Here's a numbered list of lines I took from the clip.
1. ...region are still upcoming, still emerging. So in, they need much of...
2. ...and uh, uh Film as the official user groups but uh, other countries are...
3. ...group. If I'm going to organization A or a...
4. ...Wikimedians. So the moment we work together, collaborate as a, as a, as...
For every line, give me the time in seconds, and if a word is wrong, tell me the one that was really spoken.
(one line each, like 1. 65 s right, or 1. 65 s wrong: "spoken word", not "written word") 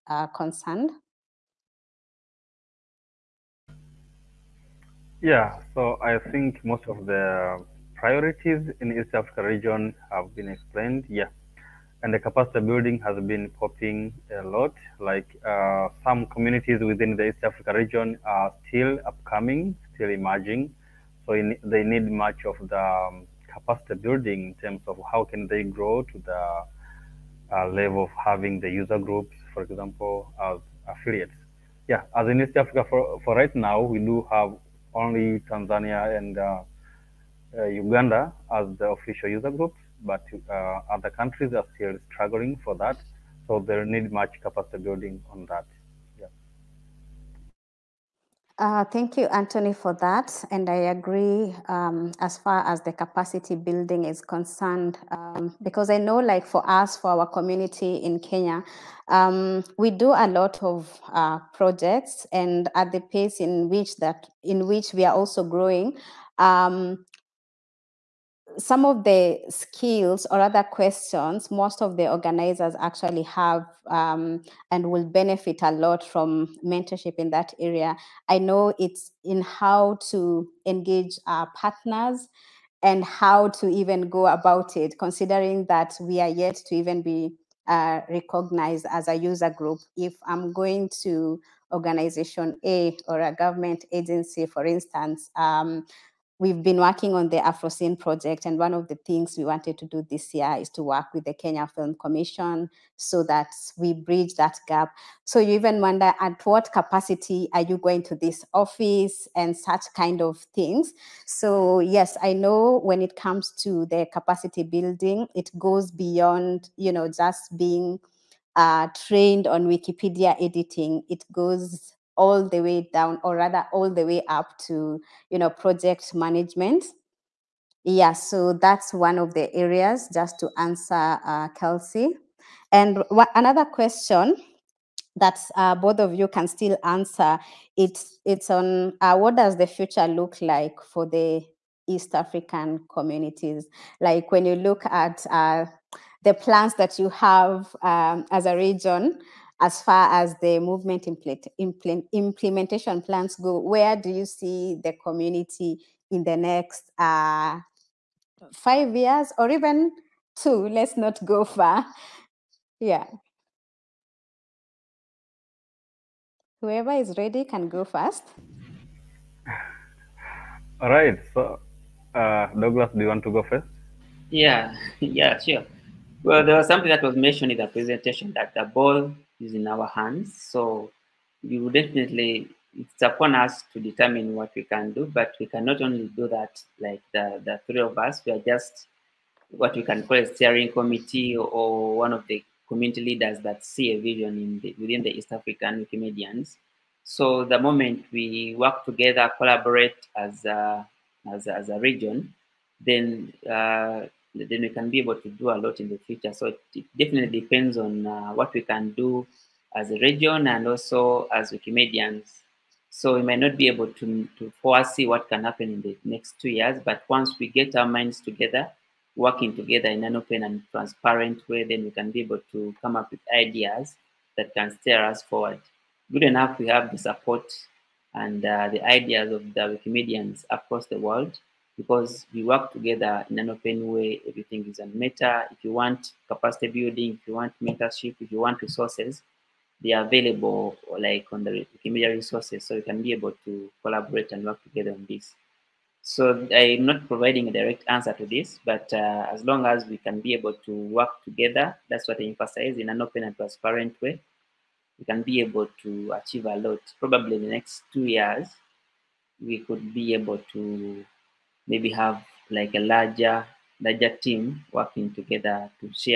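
1. 17 s right
2. 36 s wrong: "Uganda", not "Film"
3. 89 s right
4. 195 s right.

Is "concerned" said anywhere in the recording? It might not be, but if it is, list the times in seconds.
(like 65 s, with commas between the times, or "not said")
0 s, 54 s.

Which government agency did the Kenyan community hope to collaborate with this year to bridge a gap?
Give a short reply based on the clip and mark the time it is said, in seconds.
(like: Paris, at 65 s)
Kenya Film Commission, at 101 s.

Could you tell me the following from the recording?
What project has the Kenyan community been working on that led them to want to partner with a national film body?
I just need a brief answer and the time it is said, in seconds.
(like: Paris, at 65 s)
AfroCine, at 97 s.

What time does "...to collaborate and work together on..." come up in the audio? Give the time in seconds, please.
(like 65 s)
243 s.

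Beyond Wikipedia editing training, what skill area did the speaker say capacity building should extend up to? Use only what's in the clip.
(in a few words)
project management.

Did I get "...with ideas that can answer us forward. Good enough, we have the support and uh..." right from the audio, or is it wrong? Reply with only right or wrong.
wrong.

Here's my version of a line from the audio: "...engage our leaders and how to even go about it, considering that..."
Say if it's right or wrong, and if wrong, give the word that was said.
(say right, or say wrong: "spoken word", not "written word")
wrong: "partners", not "leaders".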